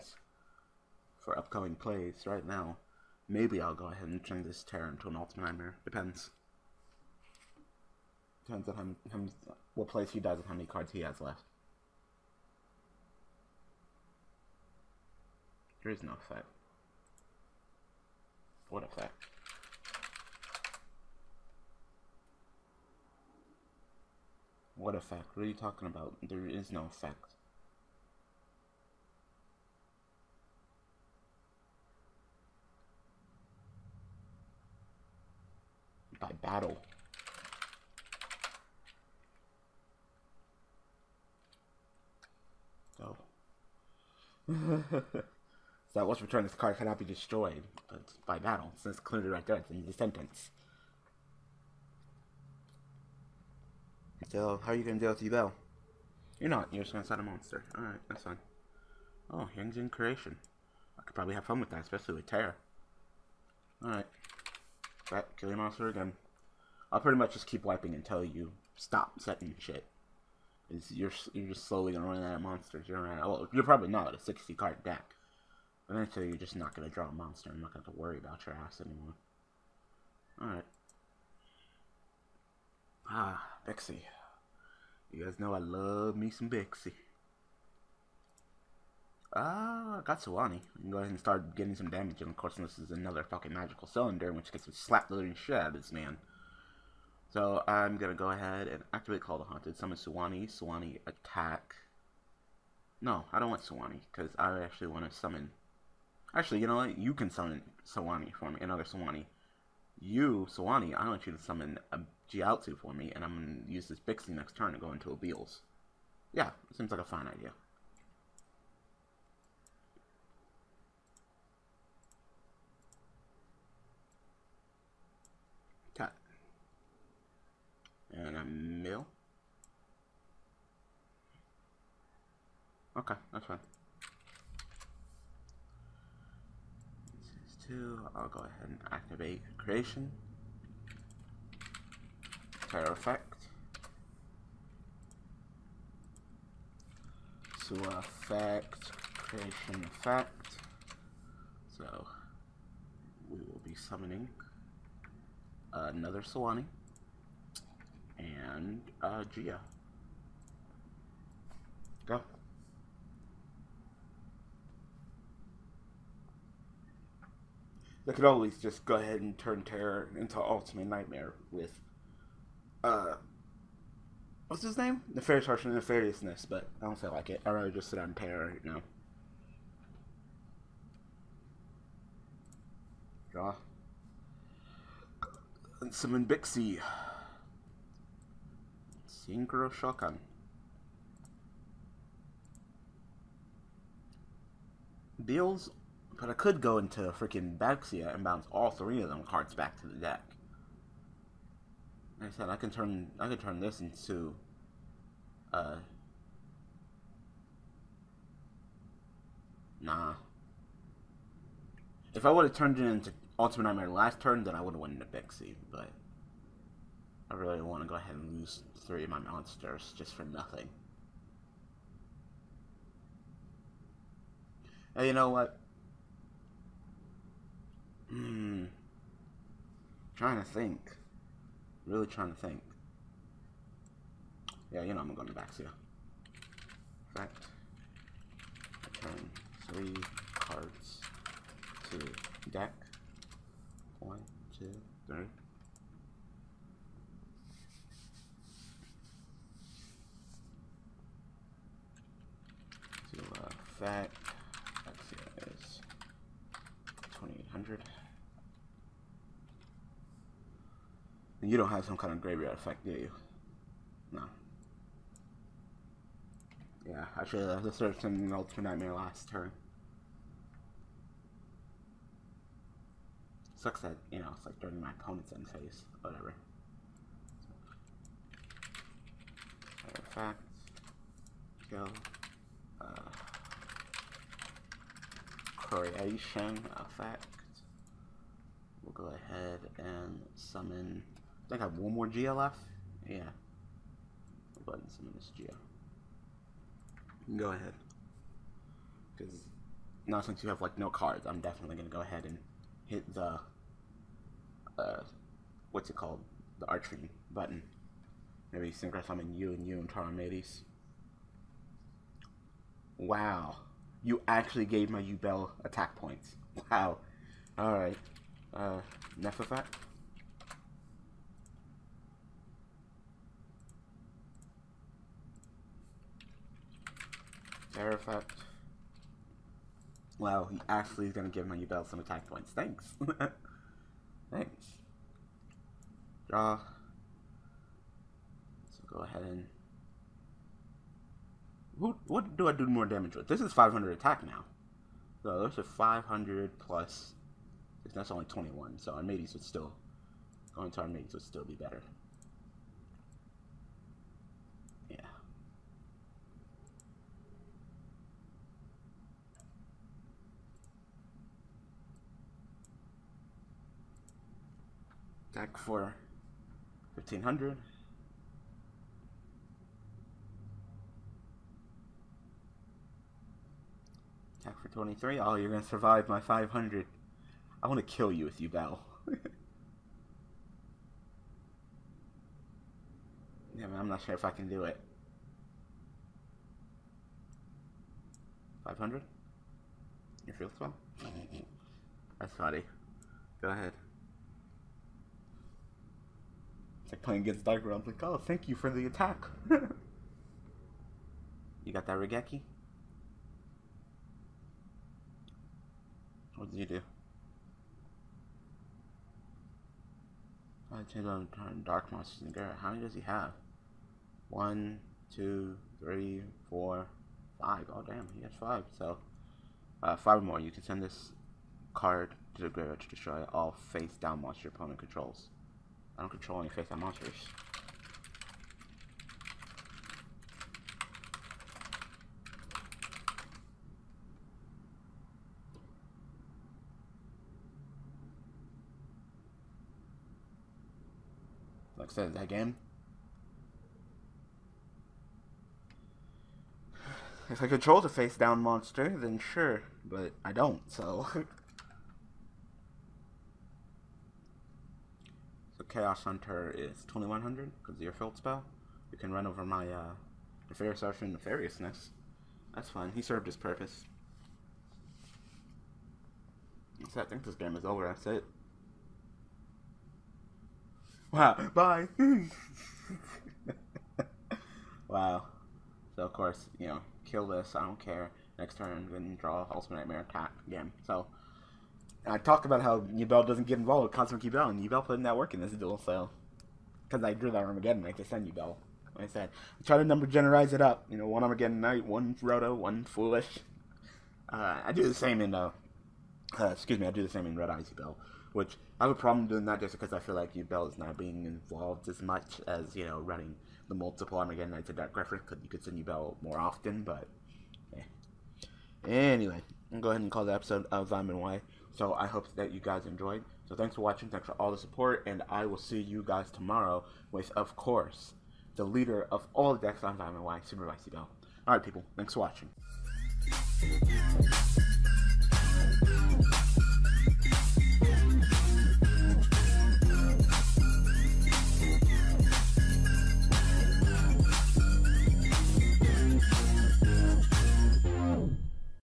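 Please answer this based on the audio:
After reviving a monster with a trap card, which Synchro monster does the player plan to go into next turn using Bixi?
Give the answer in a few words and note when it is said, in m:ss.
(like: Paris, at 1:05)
Abeals, at 1:55.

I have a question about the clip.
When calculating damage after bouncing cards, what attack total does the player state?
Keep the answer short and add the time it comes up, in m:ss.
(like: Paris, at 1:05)
2800, at 4:17.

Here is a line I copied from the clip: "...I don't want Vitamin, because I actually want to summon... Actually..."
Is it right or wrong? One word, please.
wrong.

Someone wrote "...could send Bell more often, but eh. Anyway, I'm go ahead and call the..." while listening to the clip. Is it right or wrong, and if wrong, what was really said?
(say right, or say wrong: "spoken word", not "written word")
right.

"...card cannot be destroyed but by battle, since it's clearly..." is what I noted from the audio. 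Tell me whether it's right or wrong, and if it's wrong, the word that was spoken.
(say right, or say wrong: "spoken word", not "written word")
right.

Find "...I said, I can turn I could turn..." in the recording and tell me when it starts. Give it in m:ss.
3:22.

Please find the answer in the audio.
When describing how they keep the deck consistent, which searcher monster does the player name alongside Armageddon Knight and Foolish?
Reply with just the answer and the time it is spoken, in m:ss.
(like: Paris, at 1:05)
Roto, at 8:12.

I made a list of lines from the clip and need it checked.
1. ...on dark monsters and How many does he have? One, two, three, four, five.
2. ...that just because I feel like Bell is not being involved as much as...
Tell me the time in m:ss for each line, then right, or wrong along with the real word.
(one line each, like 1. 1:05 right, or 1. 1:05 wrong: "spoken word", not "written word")
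1. 6:51 right
2. 8:19 right.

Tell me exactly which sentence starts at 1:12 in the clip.
You're gonna well, you're probably not at a 60 card deck.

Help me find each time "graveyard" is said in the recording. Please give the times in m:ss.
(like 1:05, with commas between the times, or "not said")
4:22, 7:02.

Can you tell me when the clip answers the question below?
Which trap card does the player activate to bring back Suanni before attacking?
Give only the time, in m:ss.
1:39.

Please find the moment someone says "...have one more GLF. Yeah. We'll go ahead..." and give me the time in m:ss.
4:51.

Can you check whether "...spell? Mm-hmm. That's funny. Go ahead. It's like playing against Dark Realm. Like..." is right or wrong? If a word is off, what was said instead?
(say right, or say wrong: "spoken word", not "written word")
right.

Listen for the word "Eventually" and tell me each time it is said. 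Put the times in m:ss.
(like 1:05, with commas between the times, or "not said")
1:15.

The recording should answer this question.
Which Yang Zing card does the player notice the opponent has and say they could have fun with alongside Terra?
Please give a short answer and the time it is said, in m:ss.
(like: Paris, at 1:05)
Yang Zing Creation, at 0:59.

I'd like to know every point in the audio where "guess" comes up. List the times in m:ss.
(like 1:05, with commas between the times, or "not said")
not said.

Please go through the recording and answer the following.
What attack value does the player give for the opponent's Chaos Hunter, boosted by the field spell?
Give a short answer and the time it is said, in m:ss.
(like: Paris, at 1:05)
2100, at 7:36.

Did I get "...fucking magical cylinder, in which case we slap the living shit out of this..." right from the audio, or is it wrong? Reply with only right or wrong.
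right.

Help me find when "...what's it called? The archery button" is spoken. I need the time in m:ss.
5:05.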